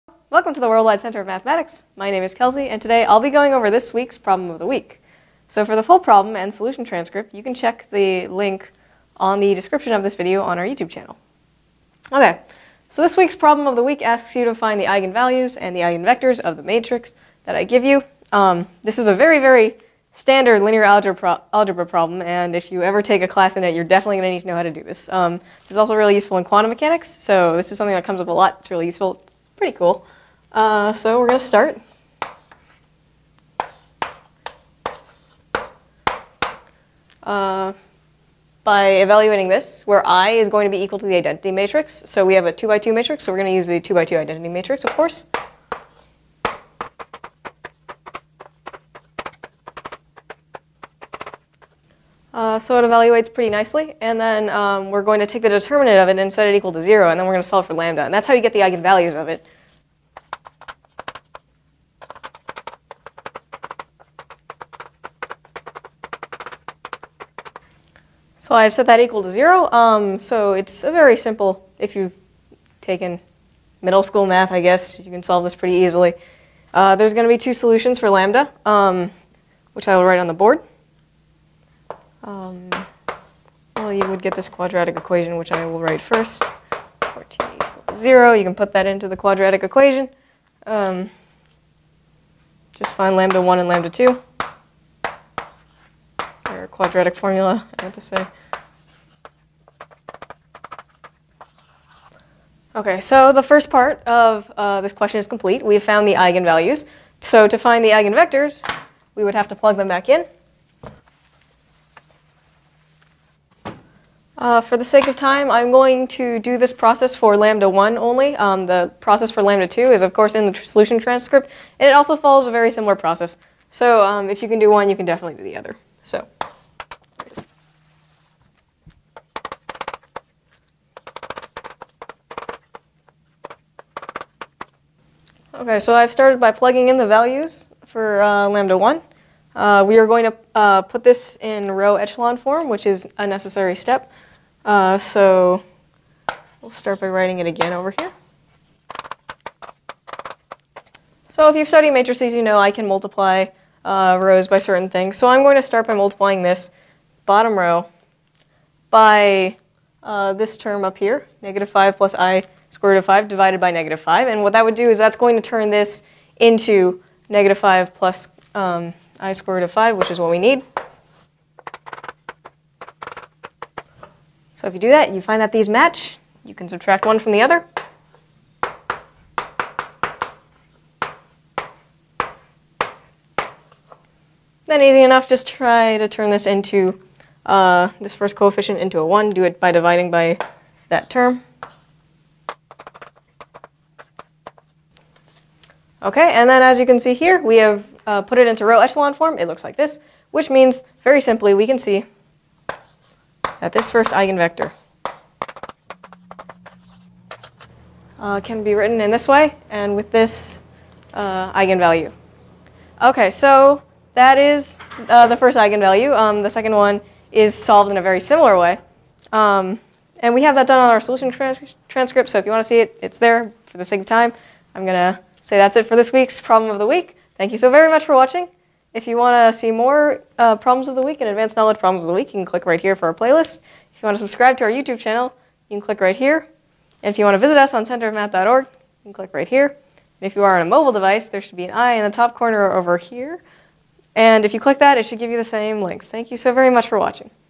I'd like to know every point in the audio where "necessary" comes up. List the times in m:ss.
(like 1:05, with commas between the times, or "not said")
2:23.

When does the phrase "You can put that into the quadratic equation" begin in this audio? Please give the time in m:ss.
1:28.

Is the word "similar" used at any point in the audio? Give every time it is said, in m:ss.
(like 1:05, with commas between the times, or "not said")
2:02, 3:38.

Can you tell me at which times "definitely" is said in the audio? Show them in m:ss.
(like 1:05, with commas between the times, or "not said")
0:23, 2:05.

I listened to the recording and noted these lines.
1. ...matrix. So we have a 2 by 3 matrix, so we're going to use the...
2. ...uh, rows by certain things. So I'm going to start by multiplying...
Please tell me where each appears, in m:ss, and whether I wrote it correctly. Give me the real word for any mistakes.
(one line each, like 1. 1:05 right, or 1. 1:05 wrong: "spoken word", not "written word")
1. 0:41 wrong: "2", not "3"
2. 2:33 right.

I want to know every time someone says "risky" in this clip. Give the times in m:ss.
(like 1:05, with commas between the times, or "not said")
not said.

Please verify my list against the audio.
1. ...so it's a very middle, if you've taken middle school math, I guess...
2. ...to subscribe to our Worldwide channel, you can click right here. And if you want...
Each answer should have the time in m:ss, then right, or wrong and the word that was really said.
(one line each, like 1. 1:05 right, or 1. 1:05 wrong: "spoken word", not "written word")
1. 1:10 wrong: "simple", not "middle"
2. 3:54 wrong: "YouTube", not "Worldwide".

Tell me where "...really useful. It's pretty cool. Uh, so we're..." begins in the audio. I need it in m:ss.
0:28.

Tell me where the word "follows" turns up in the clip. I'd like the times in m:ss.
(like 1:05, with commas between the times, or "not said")
2:02.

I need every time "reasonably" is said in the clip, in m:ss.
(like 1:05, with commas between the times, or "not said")
not said.